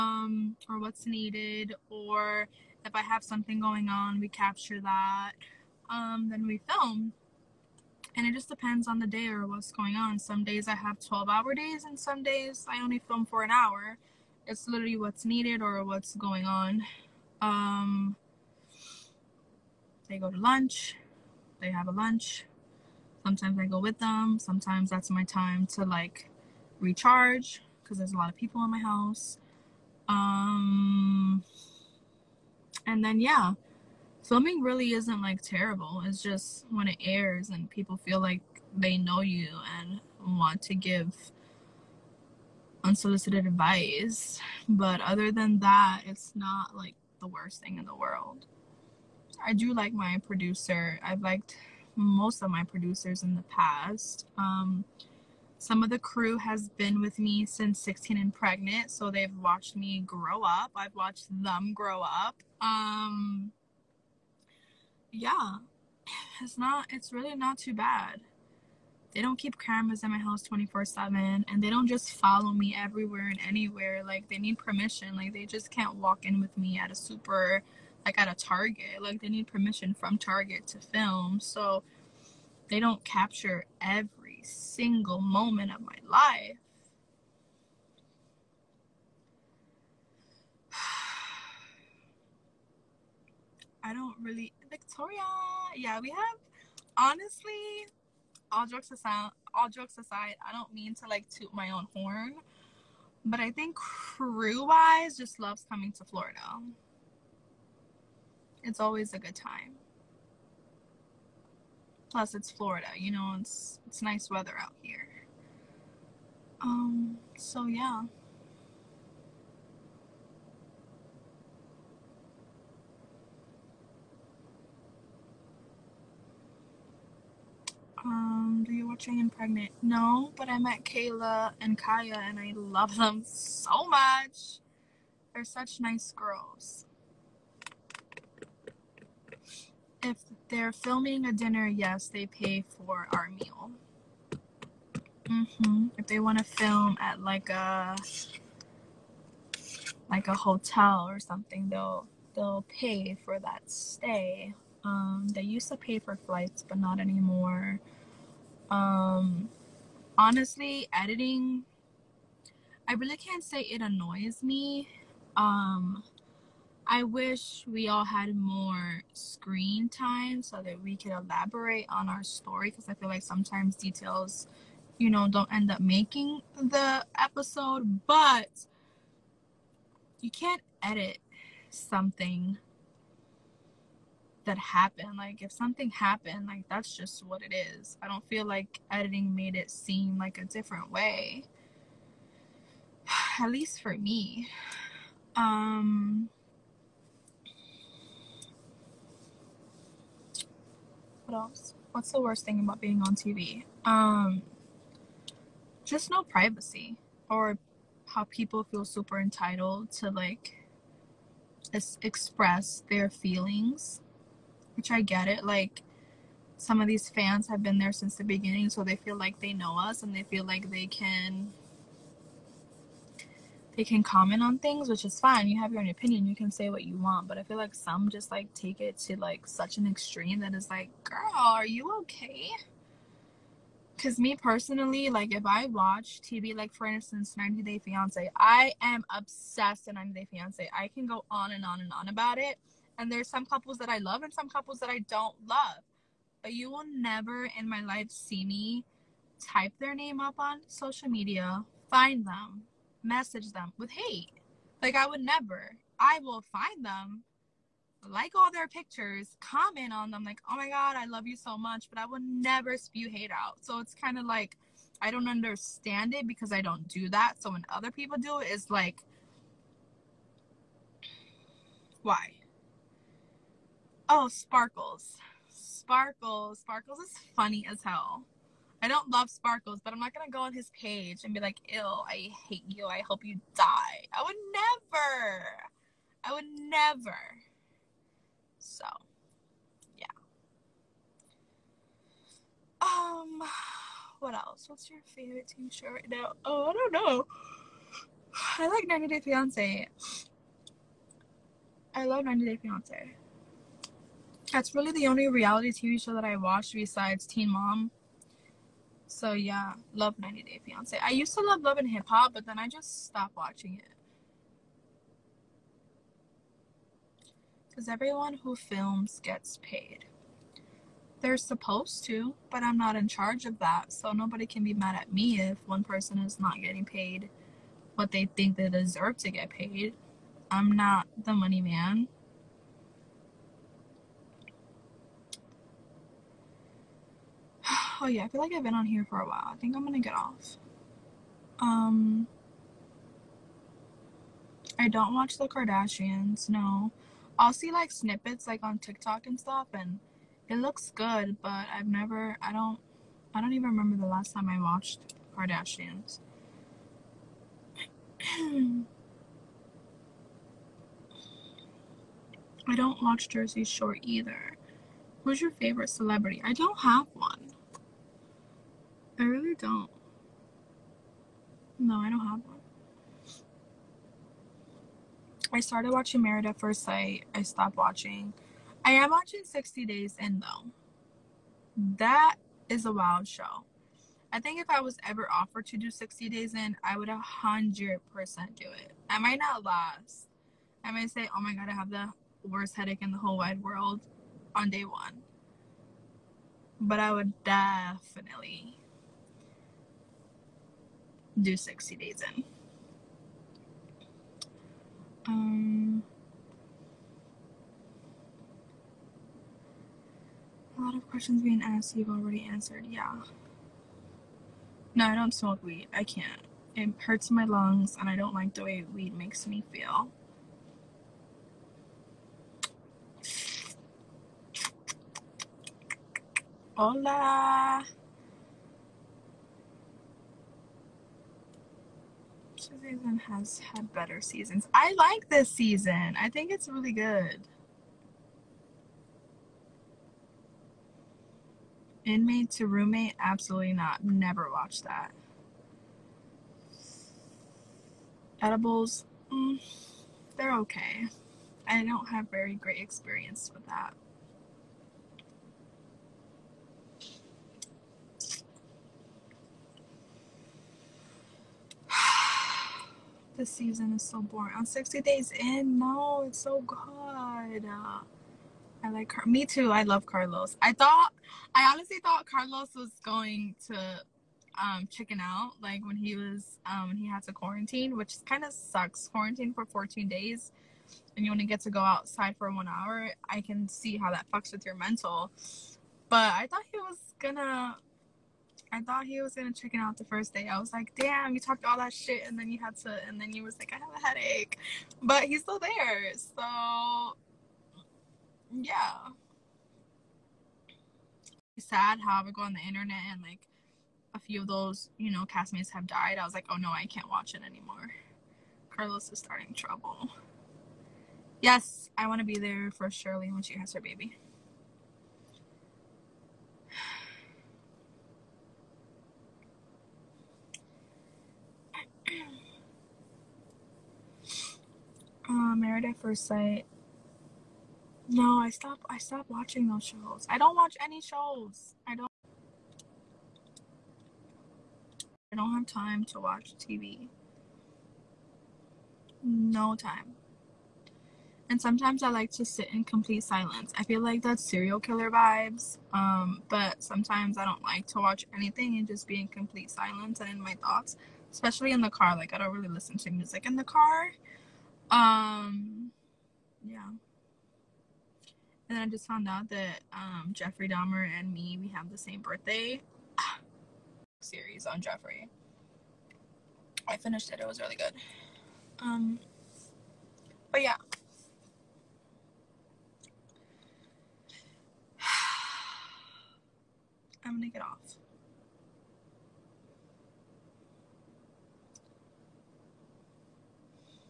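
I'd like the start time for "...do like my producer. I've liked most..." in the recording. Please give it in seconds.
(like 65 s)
49 s.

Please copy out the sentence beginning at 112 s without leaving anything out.
Plus, it's Florida, you know, it's it's nice weather out here.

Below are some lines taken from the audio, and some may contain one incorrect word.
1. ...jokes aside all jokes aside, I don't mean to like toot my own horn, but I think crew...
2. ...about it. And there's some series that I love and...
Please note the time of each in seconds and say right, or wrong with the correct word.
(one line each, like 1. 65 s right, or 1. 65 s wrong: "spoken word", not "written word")
1. 98 s right
2. 242 s wrong: "couples", not "series".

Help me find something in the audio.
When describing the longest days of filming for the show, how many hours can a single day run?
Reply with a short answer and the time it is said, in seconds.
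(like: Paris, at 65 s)
12 hours, at 10 s.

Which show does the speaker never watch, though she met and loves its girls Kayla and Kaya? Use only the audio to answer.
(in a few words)
I Pregnant.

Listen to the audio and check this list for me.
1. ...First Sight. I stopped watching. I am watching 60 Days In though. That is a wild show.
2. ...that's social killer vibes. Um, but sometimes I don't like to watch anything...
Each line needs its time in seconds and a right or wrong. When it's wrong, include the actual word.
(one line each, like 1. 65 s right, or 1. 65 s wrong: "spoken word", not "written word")
1. 376 s right
2. 544 s wrong: "serial", not "social".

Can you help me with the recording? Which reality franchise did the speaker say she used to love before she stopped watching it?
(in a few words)
Love and Hip Hop.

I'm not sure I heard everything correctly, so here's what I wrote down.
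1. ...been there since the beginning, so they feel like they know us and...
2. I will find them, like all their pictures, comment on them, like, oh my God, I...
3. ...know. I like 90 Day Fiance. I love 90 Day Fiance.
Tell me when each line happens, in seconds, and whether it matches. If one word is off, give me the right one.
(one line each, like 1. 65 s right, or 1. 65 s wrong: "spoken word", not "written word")
1. 217 s right
2. 255 s right
3. 296 s right.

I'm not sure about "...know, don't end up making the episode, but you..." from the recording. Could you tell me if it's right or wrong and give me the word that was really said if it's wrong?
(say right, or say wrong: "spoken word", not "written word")
right.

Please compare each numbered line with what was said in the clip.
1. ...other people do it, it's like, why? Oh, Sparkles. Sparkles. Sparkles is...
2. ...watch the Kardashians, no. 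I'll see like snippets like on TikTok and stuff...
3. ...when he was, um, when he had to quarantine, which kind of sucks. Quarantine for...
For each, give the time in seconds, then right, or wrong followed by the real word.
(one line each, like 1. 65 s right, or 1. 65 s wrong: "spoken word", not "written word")
1. 267 s right
2. 345 s right
3. 475 s right.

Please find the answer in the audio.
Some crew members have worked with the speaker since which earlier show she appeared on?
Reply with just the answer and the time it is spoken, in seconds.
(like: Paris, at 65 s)
16 and Pregnant, at 57 s.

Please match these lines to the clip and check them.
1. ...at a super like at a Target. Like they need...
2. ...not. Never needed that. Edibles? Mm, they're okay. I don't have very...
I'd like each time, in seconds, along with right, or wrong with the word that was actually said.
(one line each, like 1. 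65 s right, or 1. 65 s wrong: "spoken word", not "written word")
1. 76 s right
2. 443 s wrong: "watched", not "needed".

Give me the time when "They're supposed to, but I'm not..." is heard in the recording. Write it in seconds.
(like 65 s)
321 s.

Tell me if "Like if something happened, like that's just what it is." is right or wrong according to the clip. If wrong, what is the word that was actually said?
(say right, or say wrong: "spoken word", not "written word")
right.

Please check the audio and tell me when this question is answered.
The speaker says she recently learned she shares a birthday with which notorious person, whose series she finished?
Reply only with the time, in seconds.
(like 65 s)
560 s.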